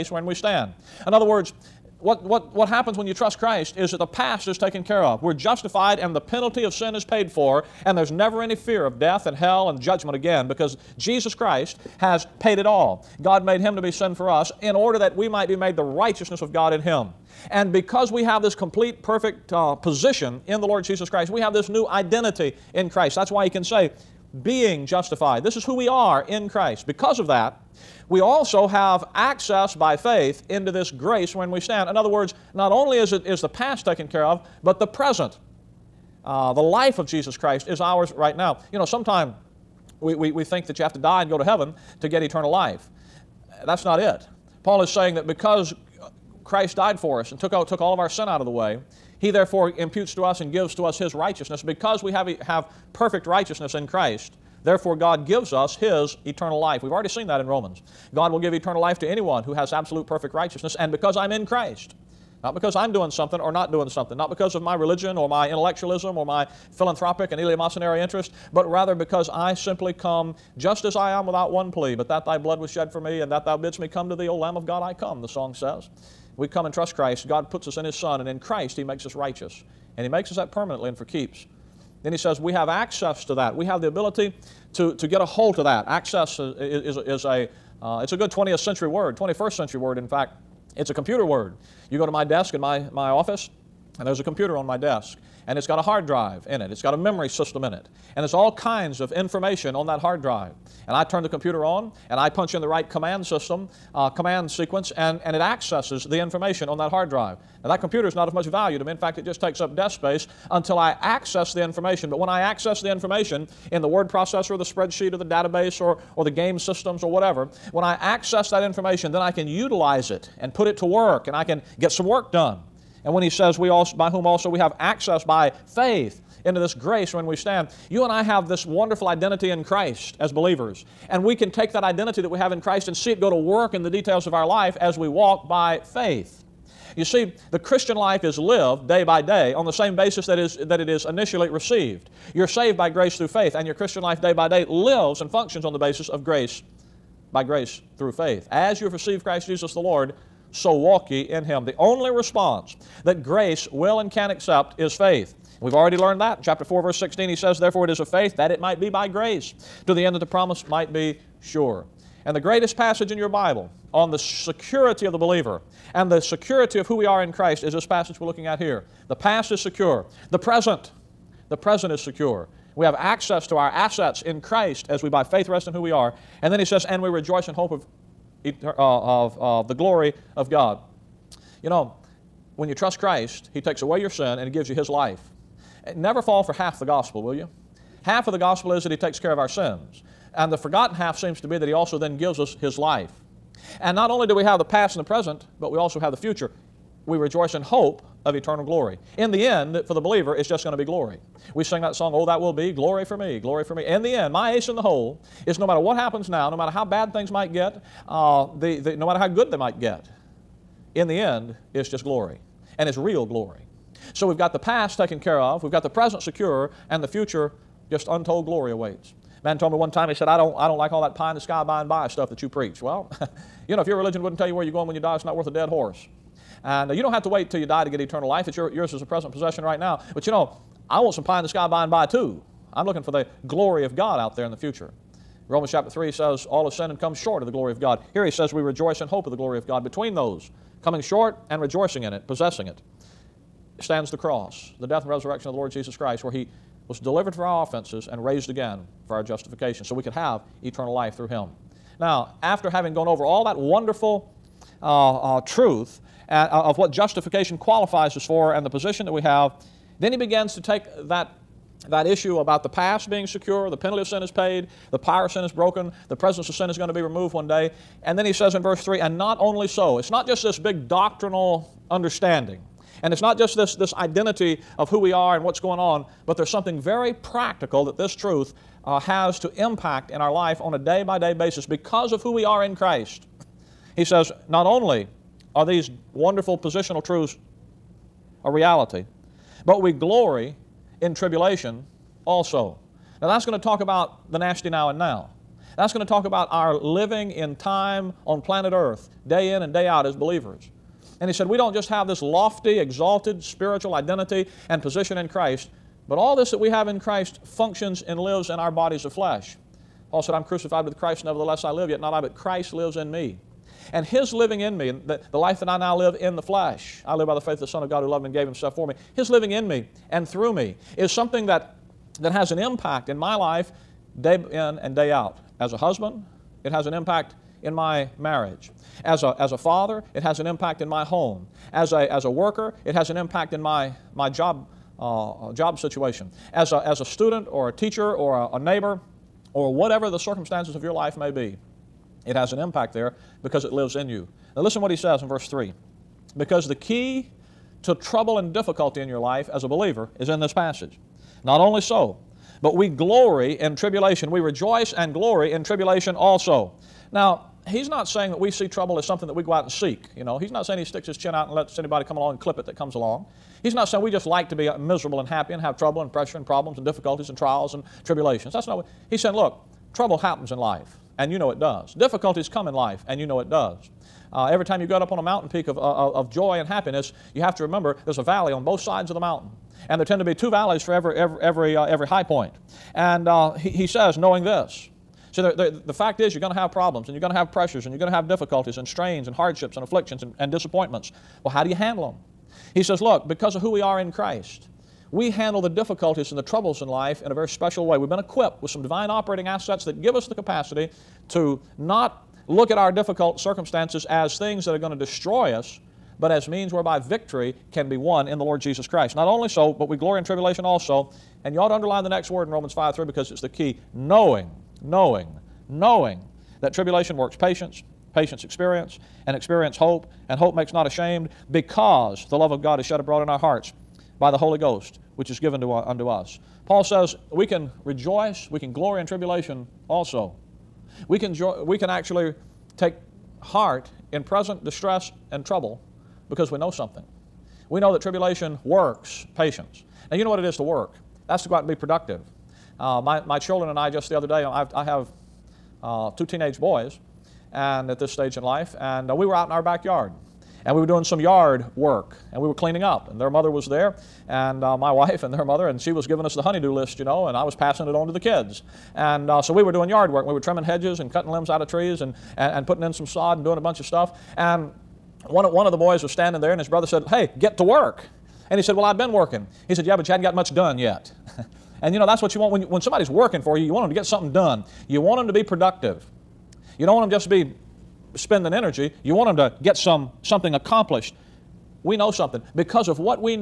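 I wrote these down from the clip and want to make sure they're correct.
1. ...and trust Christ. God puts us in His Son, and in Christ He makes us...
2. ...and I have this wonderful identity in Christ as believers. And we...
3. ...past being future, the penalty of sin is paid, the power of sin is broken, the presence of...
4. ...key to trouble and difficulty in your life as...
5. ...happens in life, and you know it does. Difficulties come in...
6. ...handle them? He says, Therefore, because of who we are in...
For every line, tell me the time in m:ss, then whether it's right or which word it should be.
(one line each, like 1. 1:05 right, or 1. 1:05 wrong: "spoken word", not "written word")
1. 1:16 right
2. 2:08 right
3. 4:22 wrong: "secure", not "future"
4. 5:46 right
5. 6:10 right
6. 6:31 wrong: "Look", not "Therefore".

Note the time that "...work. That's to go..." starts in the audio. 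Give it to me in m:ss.
7:20.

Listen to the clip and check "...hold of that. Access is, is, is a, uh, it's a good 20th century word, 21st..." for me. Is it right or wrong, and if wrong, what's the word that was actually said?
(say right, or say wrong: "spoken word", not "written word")
right.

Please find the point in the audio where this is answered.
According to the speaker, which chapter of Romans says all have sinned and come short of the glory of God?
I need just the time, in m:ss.
3:55.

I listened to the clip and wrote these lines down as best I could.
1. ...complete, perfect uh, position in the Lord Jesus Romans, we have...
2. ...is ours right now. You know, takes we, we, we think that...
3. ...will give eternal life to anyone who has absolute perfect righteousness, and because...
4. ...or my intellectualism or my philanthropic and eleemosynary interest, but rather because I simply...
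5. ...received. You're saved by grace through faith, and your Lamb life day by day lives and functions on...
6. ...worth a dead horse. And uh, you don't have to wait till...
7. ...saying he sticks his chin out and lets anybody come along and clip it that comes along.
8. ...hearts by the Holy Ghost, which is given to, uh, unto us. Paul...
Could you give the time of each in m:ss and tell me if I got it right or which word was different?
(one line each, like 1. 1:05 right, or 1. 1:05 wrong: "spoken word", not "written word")
1. 0:18 wrong: "Christ", not "Romans"
2. 0:37 wrong: "sometimes", not "takes"
3. 0:58 right
4. 1:05 right
5. 2:21 wrong: "Christian", not "Lamb"
6. 3:45 right
7. 6:00 right
8. 7:03 right.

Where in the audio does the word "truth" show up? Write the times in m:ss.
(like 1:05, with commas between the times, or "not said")
4:15, 4:38, 4:47.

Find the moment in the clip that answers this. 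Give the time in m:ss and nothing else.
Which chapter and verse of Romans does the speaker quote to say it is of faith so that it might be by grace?
2:36.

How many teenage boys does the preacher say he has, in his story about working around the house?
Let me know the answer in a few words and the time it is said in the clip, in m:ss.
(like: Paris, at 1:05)
2, at 7:26.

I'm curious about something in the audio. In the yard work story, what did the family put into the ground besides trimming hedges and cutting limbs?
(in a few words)
sod.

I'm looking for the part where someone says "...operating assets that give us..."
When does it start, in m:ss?
6:39.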